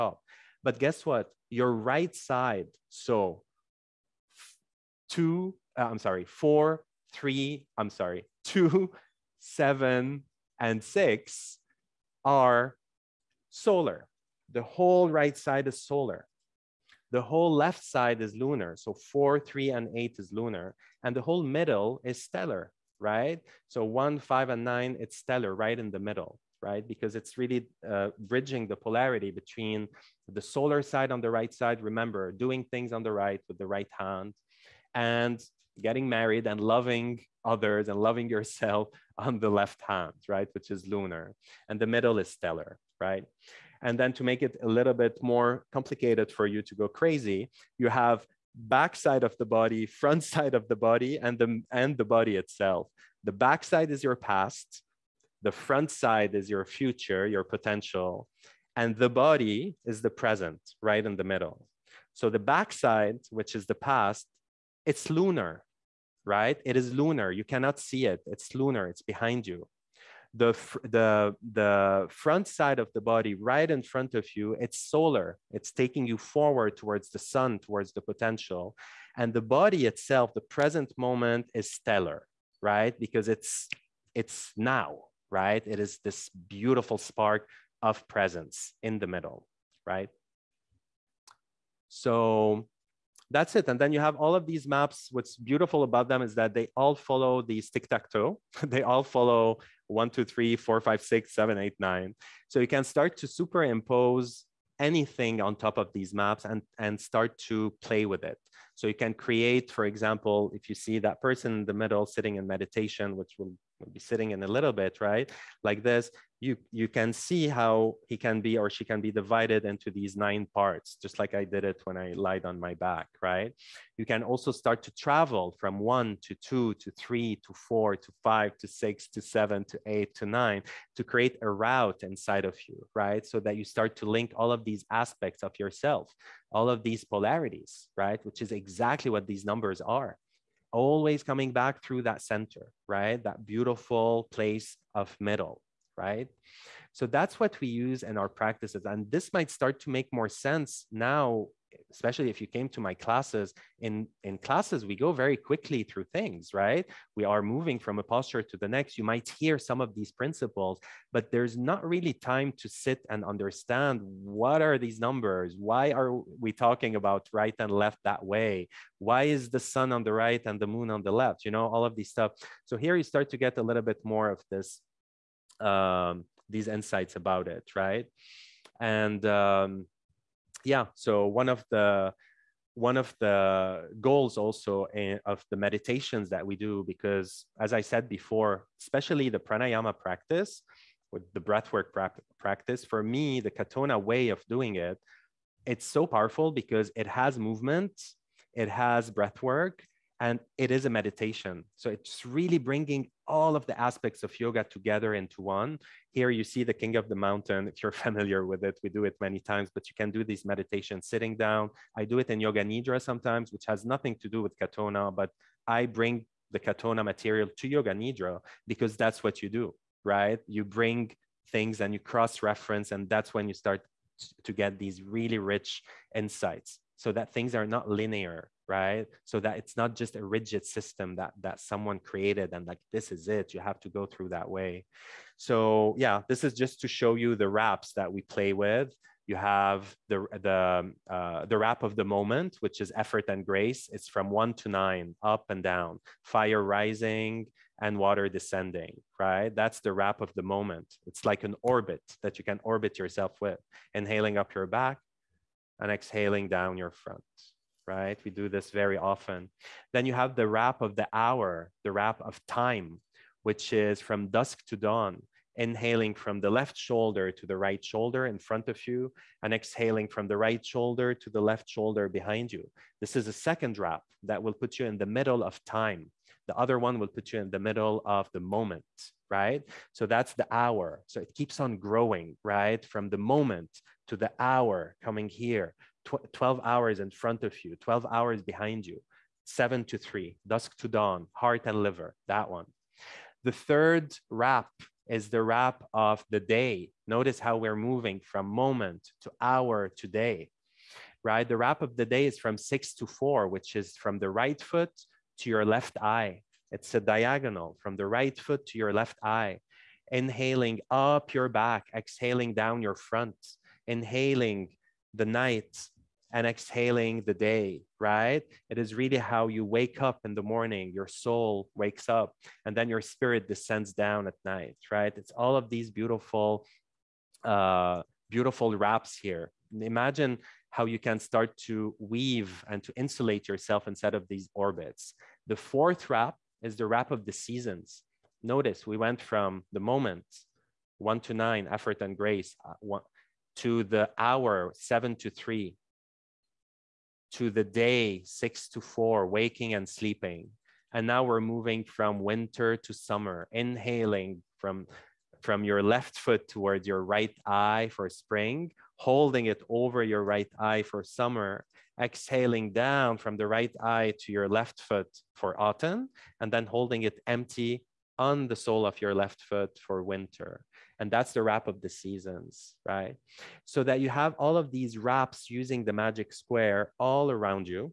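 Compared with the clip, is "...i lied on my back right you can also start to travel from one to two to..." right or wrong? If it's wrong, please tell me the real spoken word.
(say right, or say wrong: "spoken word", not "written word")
right.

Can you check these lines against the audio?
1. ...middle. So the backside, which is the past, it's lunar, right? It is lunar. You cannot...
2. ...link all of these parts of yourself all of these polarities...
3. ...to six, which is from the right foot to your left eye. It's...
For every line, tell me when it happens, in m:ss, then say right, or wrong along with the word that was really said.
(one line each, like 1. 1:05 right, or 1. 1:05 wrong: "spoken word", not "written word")
1. 1:01 right
2. 2:14 wrong: "aspects", not "parts"
3. 5:02 wrong: "four", not "six".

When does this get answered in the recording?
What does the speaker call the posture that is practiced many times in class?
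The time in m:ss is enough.
3:26.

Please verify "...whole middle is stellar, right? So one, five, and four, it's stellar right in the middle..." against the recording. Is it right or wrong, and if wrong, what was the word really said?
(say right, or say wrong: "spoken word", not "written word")
wrong: "nine", not "four".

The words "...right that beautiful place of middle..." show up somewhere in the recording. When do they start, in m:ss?
2:22.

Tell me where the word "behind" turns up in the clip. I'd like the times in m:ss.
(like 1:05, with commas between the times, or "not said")
1:09, 4:32, 4:48.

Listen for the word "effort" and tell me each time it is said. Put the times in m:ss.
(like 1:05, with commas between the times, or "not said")
4:02, 5:41.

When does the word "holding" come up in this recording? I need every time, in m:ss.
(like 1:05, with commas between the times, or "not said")
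5:58, 6:06.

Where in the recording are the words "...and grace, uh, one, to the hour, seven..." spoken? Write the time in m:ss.
5:42.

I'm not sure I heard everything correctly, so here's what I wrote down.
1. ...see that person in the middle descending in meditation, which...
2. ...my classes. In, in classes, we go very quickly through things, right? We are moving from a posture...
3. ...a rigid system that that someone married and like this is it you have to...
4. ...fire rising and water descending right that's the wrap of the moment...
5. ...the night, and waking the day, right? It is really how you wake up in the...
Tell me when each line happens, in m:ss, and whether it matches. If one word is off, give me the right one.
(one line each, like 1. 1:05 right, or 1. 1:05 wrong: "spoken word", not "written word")
1. 1:50 wrong: "sitting", not "descending"
2. 2:32 right
3. 3:50 wrong: "created", not "married"
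4. 4:06 right
5. 5:15 wrong: "exhaling", not "waking".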